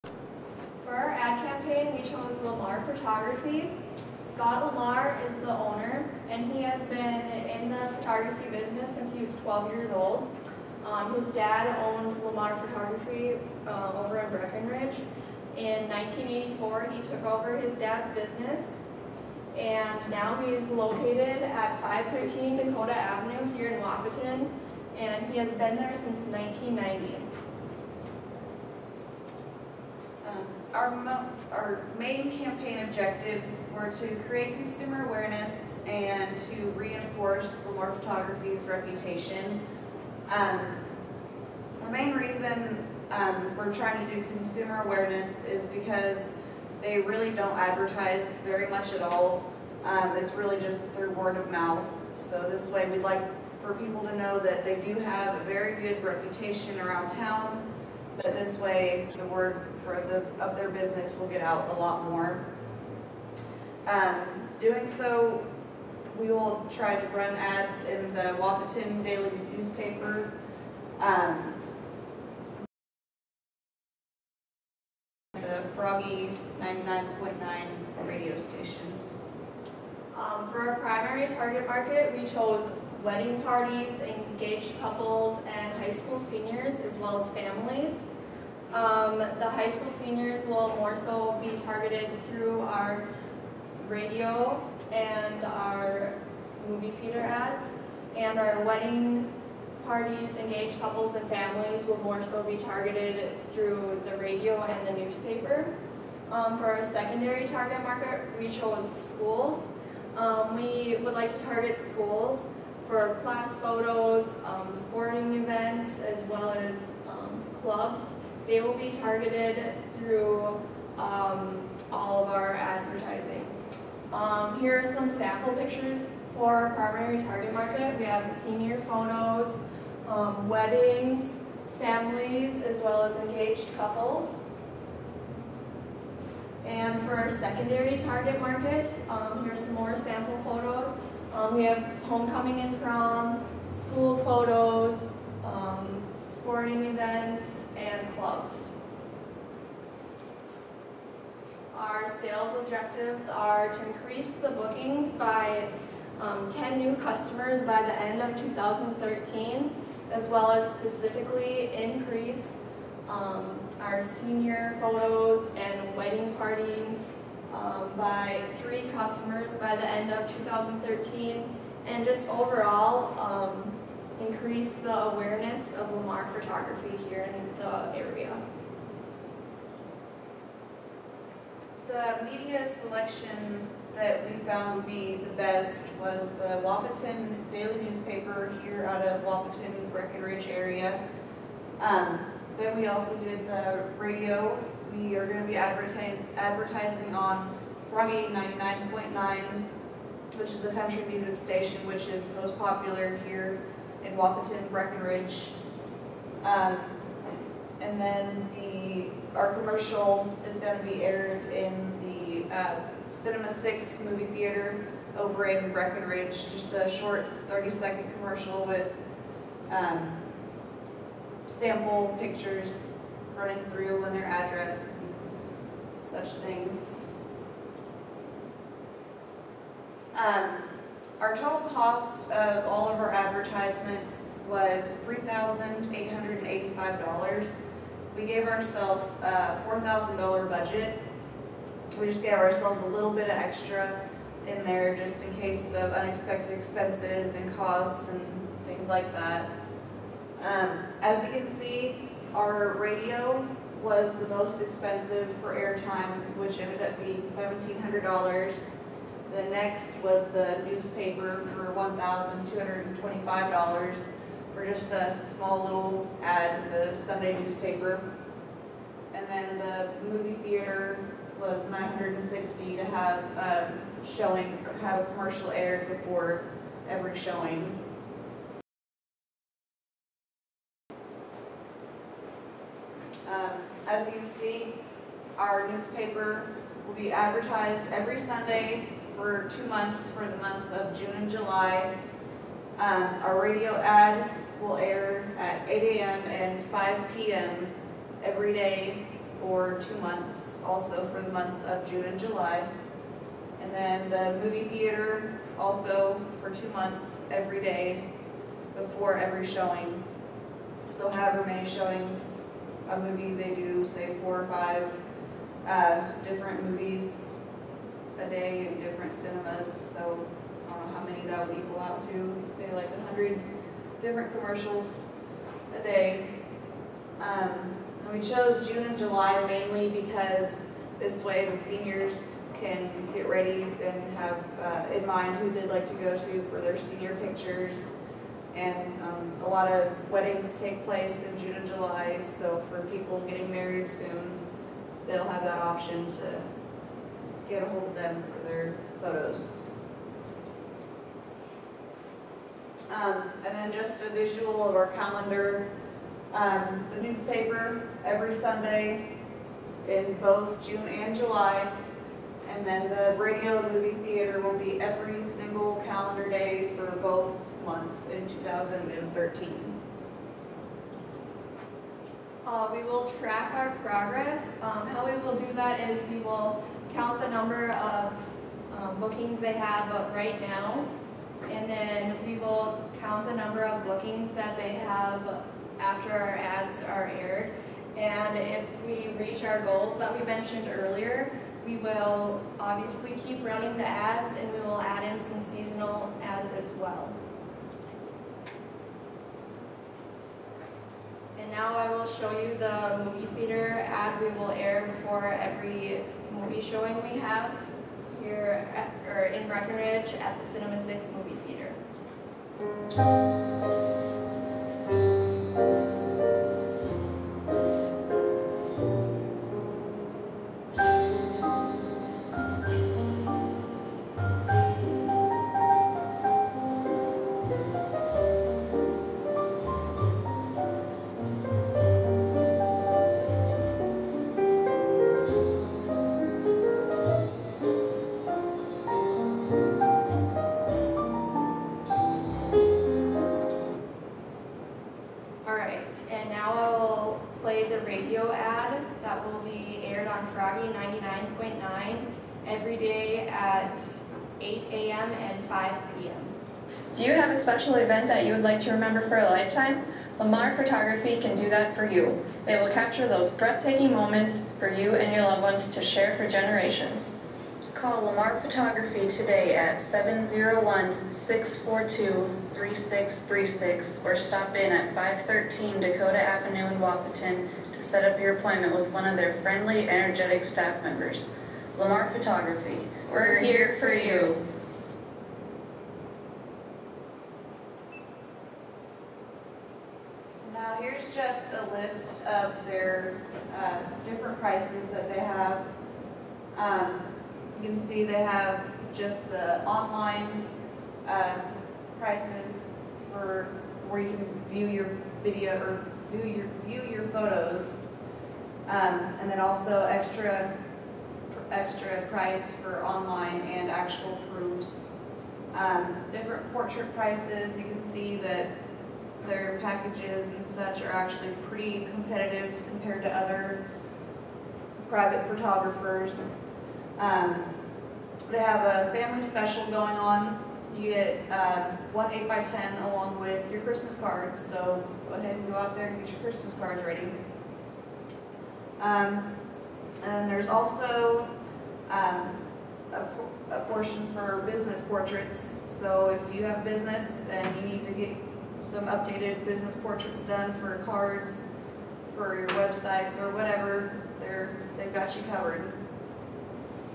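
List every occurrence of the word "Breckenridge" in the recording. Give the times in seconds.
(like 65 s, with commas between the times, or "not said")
14 s, 189 s, 204 s, 215 s, 409 s.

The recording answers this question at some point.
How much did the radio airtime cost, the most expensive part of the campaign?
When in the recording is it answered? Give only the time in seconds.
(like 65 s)
257 s.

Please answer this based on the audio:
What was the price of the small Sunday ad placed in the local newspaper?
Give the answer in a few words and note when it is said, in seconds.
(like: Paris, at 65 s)
$1,225, at 261 s.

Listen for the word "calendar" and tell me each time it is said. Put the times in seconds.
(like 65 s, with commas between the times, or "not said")
354 s, 365 s.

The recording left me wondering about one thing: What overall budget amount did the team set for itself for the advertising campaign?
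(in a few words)
$4,000.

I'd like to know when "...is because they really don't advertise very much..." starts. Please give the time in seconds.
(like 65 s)
45 s.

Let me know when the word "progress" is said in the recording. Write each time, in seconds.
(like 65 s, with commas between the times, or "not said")
373 s.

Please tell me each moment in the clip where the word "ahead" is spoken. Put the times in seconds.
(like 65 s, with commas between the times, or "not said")
535 s.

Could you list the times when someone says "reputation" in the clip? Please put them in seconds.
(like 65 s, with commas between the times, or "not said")
38 s, 56 s.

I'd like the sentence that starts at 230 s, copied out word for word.
Um, our total cost of all of our advertisements was $3,885.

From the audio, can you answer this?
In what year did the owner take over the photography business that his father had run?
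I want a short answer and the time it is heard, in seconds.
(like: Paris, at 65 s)
1984, at 15 s.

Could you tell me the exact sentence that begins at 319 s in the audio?
So I don't know how many that would equal out to, say like 100 different commercials a day.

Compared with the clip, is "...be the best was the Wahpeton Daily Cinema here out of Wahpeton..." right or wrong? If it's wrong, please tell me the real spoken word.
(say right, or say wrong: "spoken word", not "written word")
wrong: "Newspaper", not "Cinema".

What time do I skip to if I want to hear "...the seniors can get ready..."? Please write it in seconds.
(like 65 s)
331 s.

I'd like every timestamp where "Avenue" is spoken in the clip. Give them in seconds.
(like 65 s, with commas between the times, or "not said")
22 s, 476 s.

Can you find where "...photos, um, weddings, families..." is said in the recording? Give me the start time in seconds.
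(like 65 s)
128 s.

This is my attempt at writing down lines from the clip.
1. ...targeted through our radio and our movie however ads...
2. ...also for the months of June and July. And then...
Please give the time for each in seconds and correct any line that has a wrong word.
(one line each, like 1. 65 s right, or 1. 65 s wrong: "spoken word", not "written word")
1. 91 s wrong: "theater", not "however"
2. 300 s right.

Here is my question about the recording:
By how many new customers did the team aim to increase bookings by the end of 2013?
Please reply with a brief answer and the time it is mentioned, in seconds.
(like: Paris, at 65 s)
10, at 156 s.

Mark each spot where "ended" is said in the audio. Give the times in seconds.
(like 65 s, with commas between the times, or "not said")
256 s.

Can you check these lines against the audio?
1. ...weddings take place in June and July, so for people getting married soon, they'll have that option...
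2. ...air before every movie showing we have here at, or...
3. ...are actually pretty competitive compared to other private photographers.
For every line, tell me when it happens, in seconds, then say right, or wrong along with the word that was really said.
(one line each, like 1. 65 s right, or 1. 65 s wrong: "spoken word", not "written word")
1. 340 s right
2. 404 s right
3. 520 s right.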